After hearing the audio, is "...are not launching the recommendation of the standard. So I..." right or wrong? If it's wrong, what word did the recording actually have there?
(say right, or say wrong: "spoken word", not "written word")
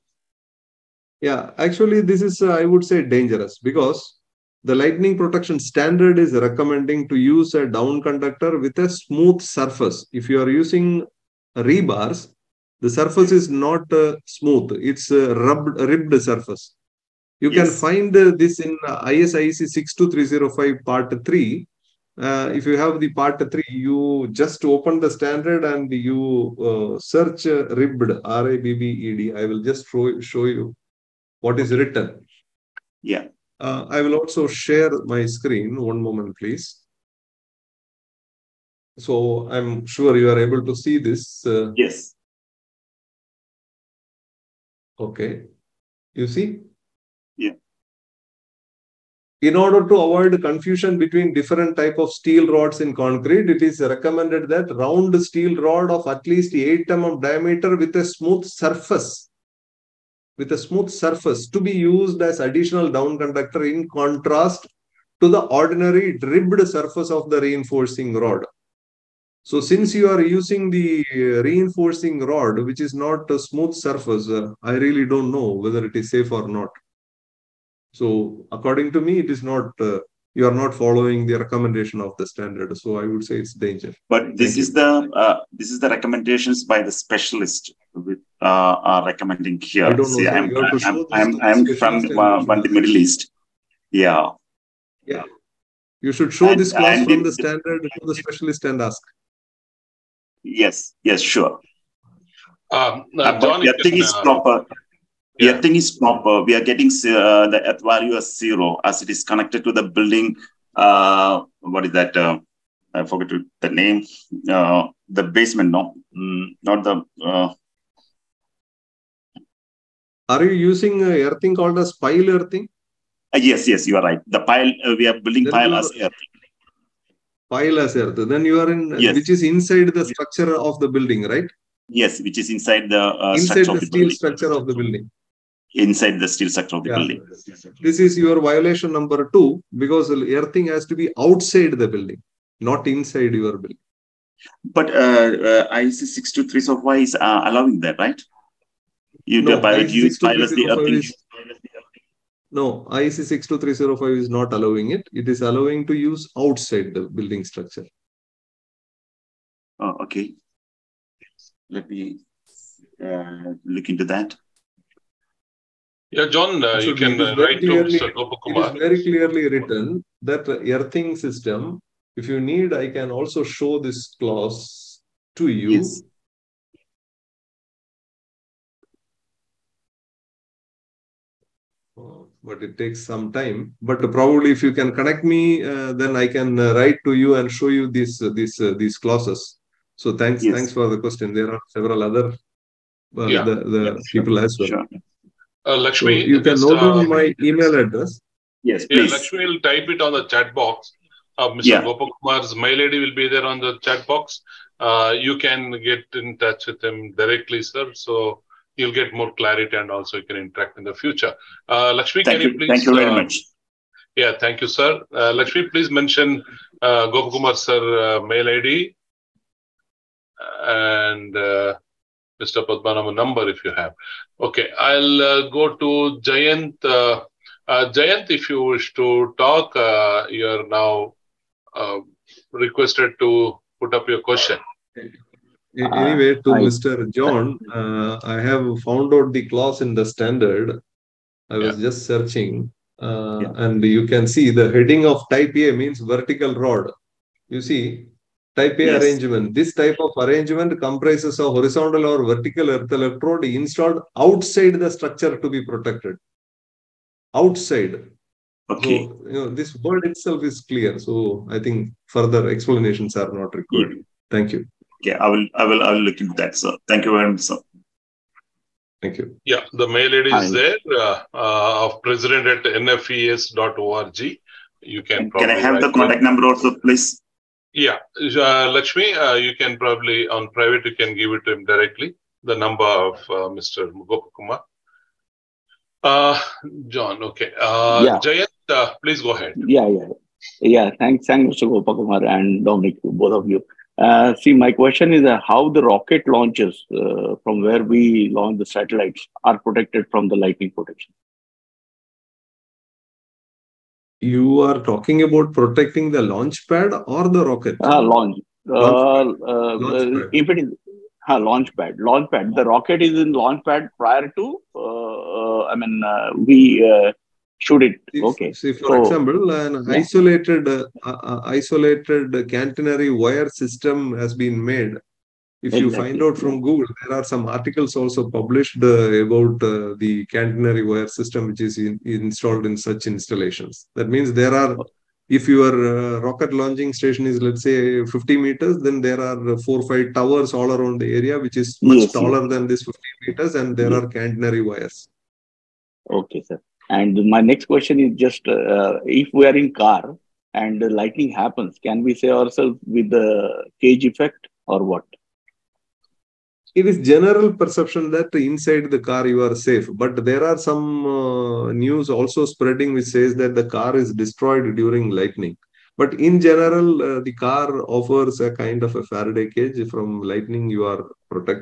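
wrong: "following", not "launching".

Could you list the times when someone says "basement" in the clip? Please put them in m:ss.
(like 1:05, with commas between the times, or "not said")
1:55.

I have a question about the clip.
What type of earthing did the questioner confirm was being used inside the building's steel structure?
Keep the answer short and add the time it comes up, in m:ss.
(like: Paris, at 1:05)
pile earthing, at 2:01.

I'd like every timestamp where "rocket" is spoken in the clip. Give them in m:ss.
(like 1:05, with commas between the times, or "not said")
4:55, 5:07, 5:12, 5:36.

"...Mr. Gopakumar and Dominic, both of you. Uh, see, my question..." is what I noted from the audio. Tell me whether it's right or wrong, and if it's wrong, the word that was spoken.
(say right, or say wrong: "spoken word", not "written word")
right.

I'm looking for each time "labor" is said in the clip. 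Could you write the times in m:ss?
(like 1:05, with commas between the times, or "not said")
not said.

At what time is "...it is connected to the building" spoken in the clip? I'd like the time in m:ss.
1:49.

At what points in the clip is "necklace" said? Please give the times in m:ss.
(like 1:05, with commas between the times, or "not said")
not said.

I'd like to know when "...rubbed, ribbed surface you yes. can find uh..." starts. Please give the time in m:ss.
0:15.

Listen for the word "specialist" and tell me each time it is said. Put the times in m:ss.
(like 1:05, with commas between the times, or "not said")
1:26, 1:38.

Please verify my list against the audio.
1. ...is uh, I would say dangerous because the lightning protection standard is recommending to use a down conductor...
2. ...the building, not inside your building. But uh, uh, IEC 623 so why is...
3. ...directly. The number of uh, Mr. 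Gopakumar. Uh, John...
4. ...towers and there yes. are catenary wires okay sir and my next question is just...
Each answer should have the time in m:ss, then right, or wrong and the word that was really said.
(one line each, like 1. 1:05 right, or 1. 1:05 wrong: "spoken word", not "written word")
1. 0:02 right
2. 2:21 right
3. 4:41 right
4. 5:43 wrong: "meters", not "towers".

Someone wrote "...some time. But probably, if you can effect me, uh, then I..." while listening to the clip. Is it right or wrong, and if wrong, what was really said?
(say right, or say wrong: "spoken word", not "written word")
wrong: "connect", not "effect".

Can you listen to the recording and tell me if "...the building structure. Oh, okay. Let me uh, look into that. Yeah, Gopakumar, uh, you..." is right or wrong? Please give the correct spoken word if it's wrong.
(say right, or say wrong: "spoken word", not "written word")
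wrong: "John", not "Gopakumar".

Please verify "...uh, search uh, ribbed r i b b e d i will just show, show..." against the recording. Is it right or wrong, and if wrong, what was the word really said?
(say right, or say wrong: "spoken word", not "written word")
right.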